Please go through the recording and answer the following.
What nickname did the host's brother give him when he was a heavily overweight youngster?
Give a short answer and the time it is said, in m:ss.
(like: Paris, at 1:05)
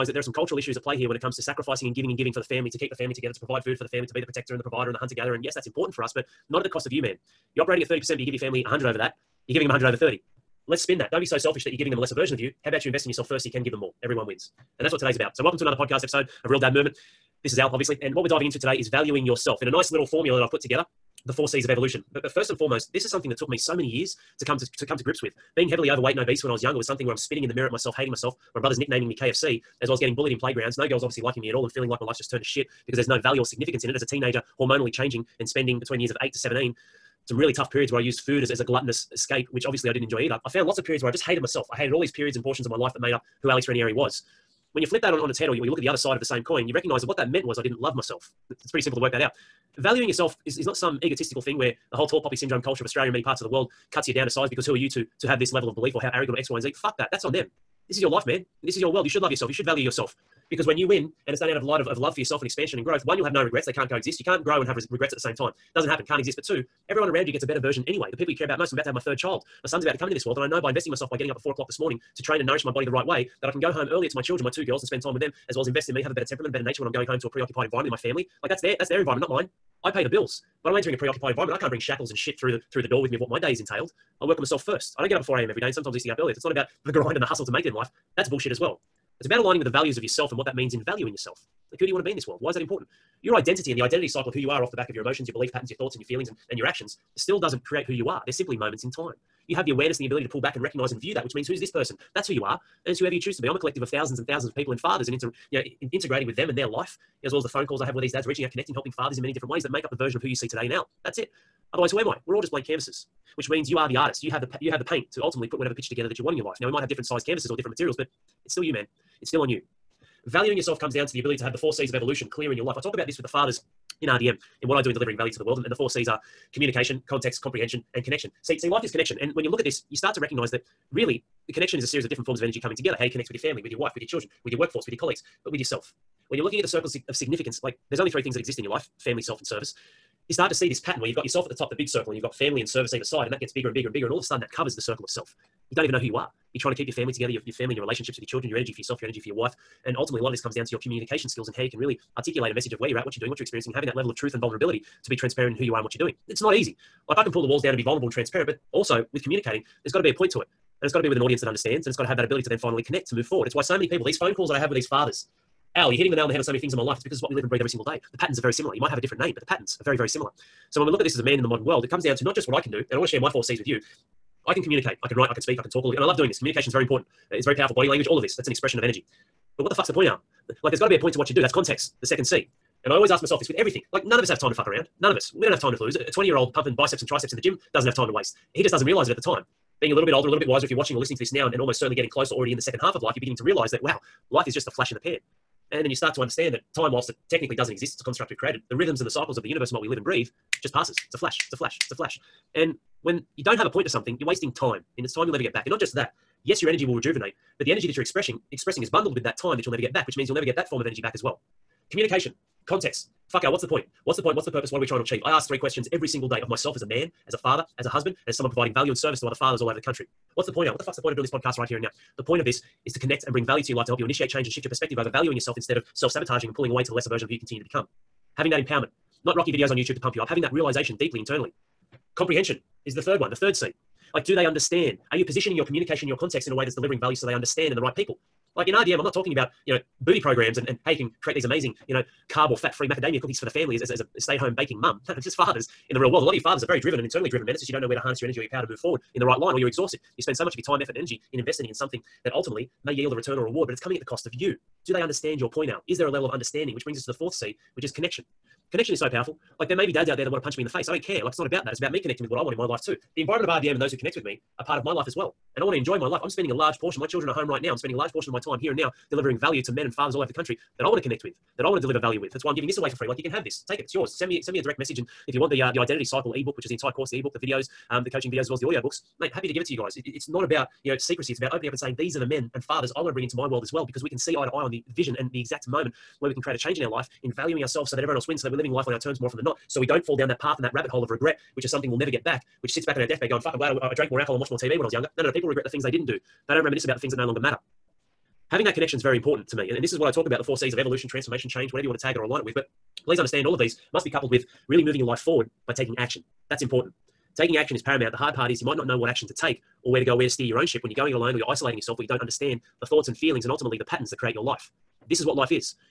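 KFC, at 0:29.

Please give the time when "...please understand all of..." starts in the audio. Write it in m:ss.
5:03.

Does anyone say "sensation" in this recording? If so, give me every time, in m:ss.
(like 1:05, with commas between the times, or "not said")
not said.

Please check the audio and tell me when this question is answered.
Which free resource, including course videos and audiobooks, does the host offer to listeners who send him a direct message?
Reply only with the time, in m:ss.
4:35.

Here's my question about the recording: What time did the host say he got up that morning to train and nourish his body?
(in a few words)
4 a.m.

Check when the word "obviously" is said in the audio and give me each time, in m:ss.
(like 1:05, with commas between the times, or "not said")
0:17, 0:31, 0:39.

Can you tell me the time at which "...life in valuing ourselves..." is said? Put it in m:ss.
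4:46.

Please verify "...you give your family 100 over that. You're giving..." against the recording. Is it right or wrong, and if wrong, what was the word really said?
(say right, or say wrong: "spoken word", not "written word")
right.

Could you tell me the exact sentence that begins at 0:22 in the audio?
But, but first and foremost, this is something that took me so many years to come to, to come to grips with.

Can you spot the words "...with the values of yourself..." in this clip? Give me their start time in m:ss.
1:29.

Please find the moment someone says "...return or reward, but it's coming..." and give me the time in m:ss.
4:13.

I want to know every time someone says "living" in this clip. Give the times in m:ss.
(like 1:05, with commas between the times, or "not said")
4:48.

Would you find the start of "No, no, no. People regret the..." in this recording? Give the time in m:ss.
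4:55.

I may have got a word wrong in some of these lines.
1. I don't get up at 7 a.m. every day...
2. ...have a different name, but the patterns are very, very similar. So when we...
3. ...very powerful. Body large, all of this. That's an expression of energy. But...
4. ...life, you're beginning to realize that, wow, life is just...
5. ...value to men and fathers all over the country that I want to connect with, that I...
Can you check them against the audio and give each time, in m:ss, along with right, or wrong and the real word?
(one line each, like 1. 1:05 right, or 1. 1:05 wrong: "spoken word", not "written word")
1. 1:24 wrong: "4", not "7"
2. 2:48 right
3. 2:57 wrong: "language", not "large"
4. 3:13 right
5. 4:29 right.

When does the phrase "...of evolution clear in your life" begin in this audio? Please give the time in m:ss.
2:01.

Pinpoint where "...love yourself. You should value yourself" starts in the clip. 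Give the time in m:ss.
0:59.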